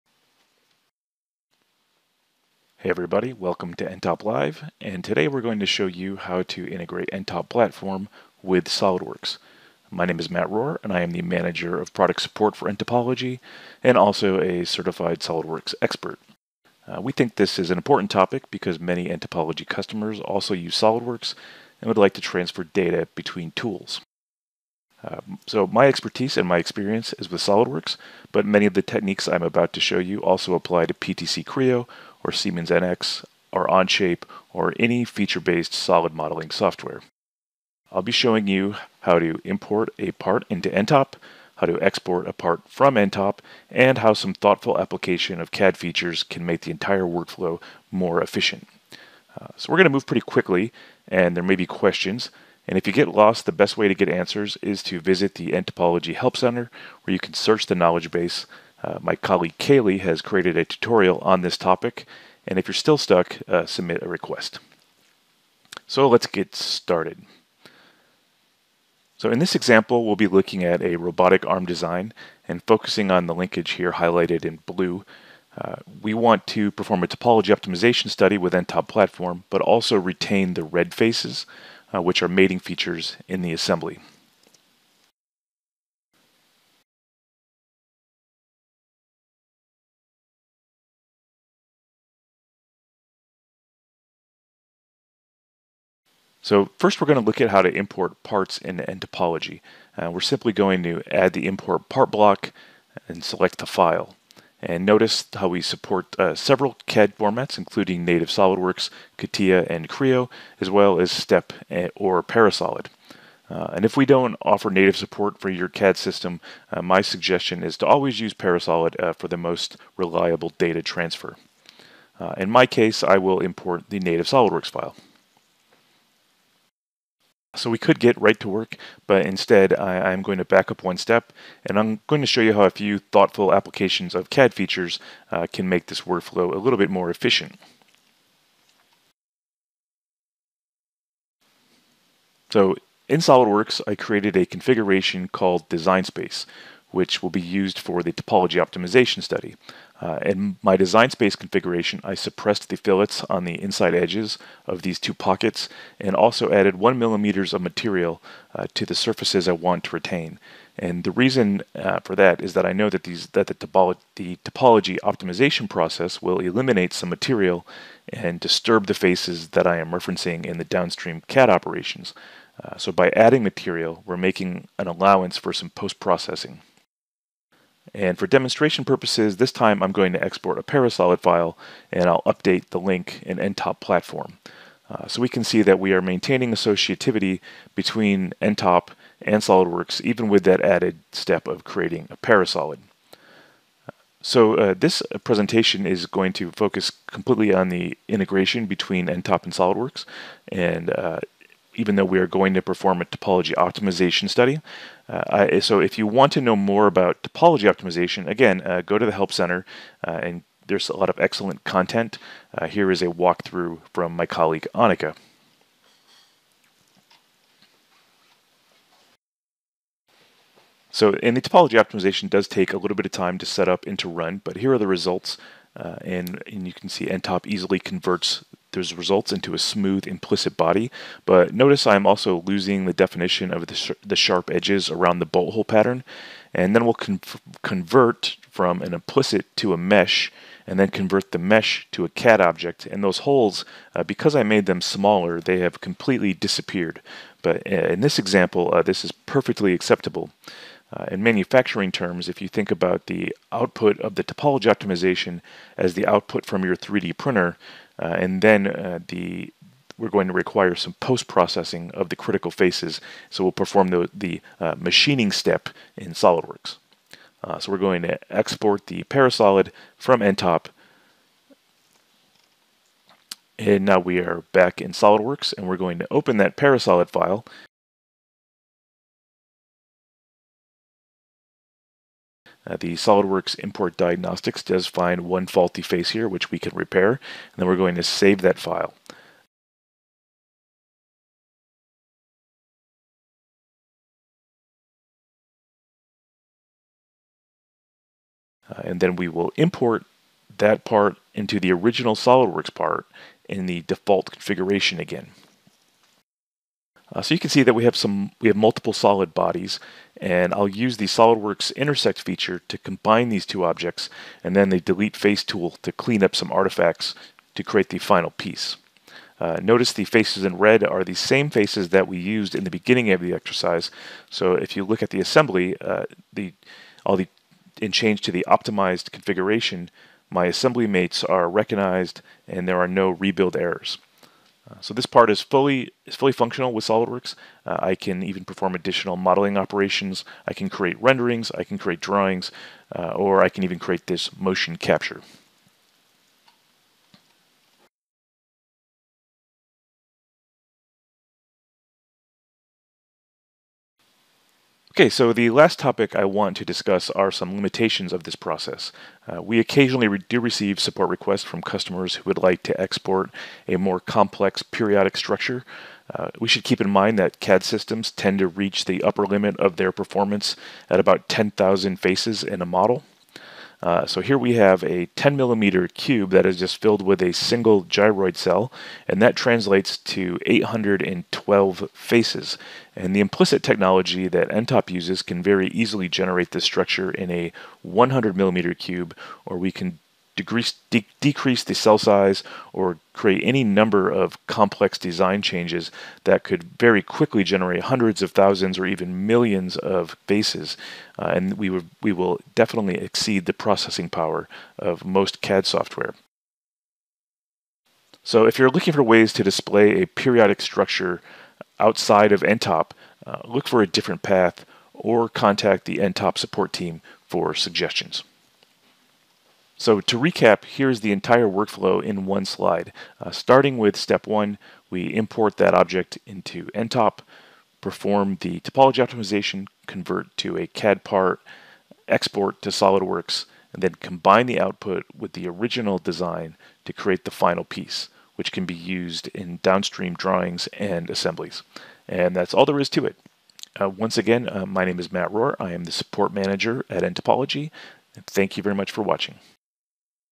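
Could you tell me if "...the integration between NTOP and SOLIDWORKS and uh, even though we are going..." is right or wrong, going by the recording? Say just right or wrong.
right.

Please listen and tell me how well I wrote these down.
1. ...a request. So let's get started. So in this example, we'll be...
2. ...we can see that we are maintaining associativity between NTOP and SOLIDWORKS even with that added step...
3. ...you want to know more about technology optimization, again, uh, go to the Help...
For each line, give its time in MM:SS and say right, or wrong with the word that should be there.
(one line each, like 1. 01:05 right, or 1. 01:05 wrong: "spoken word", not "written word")
1. 01:04 right
2. 03:05 right
3. 03:25 wrong: "topology", not "technology".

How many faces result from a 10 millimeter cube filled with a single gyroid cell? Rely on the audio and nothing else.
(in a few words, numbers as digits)
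812.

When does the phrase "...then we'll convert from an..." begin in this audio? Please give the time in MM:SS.
03:56.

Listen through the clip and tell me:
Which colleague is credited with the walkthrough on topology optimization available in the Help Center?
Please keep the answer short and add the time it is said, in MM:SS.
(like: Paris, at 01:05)
Annika, at 03:34.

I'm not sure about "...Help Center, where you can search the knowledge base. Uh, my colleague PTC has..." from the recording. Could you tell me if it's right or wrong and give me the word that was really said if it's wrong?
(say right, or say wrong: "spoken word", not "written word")
wrong: "Kaylee", not "PTC".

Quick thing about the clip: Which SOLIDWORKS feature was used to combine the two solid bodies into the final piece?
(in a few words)
intersect.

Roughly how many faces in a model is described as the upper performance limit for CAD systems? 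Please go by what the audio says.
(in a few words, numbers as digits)
10,000.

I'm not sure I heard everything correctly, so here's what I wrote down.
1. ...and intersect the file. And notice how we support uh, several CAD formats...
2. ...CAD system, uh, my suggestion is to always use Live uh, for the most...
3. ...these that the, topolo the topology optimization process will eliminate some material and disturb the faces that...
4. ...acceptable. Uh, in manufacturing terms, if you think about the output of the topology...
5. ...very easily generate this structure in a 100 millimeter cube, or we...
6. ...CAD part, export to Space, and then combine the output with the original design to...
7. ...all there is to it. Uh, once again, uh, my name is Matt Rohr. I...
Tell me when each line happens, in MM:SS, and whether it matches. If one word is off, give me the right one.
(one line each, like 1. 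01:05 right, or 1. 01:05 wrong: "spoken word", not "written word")
1. 01:43 wrong: "select", not "intersect"
2. 01:55 wrong: "Parasolid", not "Live"
3. 02:43 right
4. 04:09 right
5. 06:25 right
6. 07:10 wrong: "SOLIDWORKS", not "Space"
7. 07:22 right.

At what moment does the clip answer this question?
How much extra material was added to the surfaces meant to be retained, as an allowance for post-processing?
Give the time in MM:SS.
02:36.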